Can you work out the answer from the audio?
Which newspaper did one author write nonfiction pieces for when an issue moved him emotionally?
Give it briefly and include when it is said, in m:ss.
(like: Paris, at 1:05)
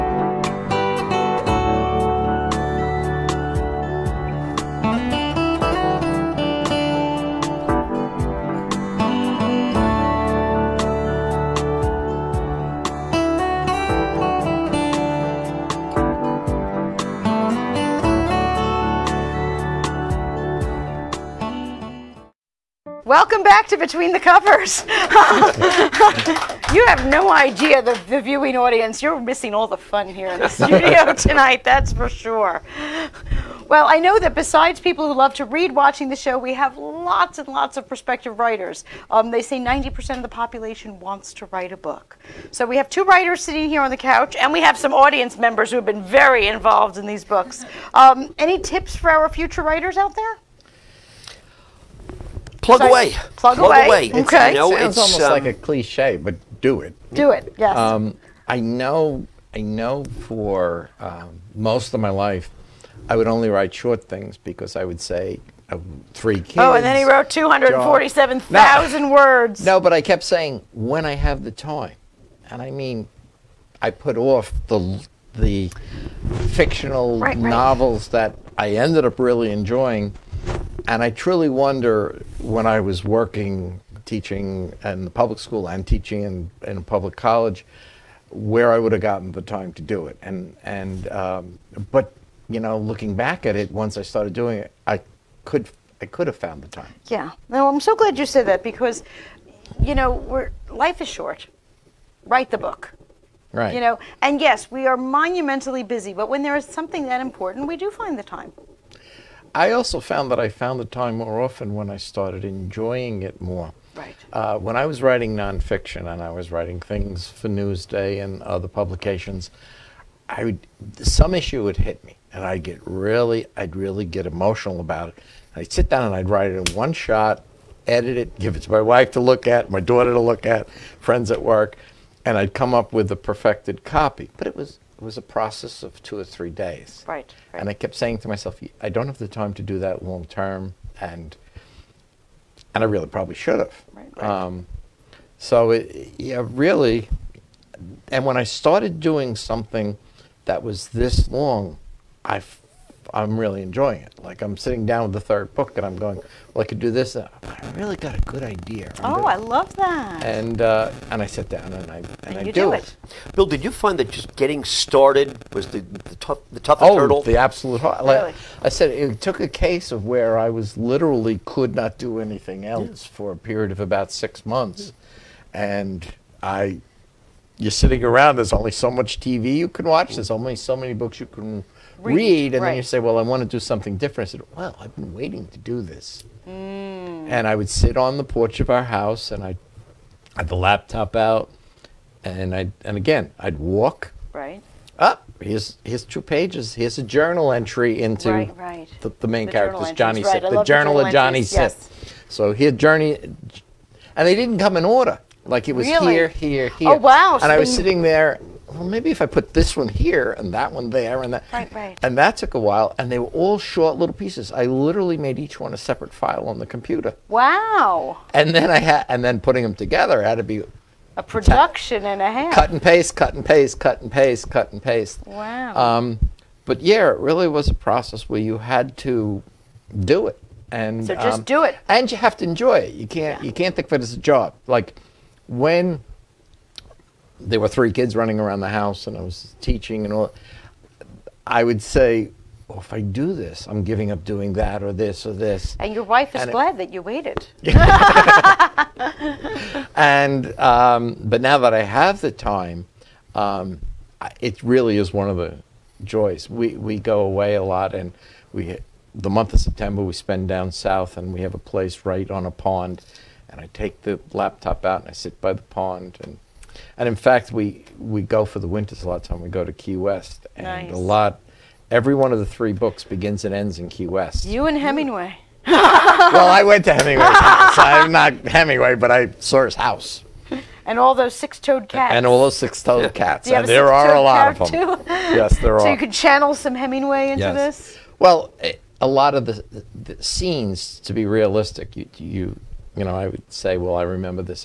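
Newsday, at 1:57.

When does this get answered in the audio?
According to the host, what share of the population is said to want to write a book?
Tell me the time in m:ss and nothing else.
0:39.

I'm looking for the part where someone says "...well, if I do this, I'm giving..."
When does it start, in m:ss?
4:02.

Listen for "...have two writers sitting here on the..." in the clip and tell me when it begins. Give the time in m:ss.
0:42.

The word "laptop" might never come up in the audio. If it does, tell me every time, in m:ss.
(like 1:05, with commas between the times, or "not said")
3:10, 4:24.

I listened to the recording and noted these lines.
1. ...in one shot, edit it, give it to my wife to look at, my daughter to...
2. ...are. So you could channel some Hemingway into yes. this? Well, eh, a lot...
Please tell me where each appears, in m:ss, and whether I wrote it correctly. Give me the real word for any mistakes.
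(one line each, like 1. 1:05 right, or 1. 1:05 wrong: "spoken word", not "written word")
1. 2:06 right
2. 4:45 right.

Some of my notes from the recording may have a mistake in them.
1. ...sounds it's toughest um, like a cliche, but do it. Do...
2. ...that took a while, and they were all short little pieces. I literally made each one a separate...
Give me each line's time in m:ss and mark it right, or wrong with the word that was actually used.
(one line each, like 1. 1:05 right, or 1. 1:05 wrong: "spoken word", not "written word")
1. 0:54 wrong: "almost", not "toughest"
2. 3:32 right.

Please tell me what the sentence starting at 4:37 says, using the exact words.
I'm not Hemingway, but I saw his house.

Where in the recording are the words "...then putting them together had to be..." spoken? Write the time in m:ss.
3:39.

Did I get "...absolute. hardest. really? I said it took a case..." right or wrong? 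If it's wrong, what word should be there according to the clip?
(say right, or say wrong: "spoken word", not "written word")
right.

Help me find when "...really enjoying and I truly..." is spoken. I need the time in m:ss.
1:19.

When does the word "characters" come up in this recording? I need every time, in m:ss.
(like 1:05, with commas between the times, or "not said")
3:19.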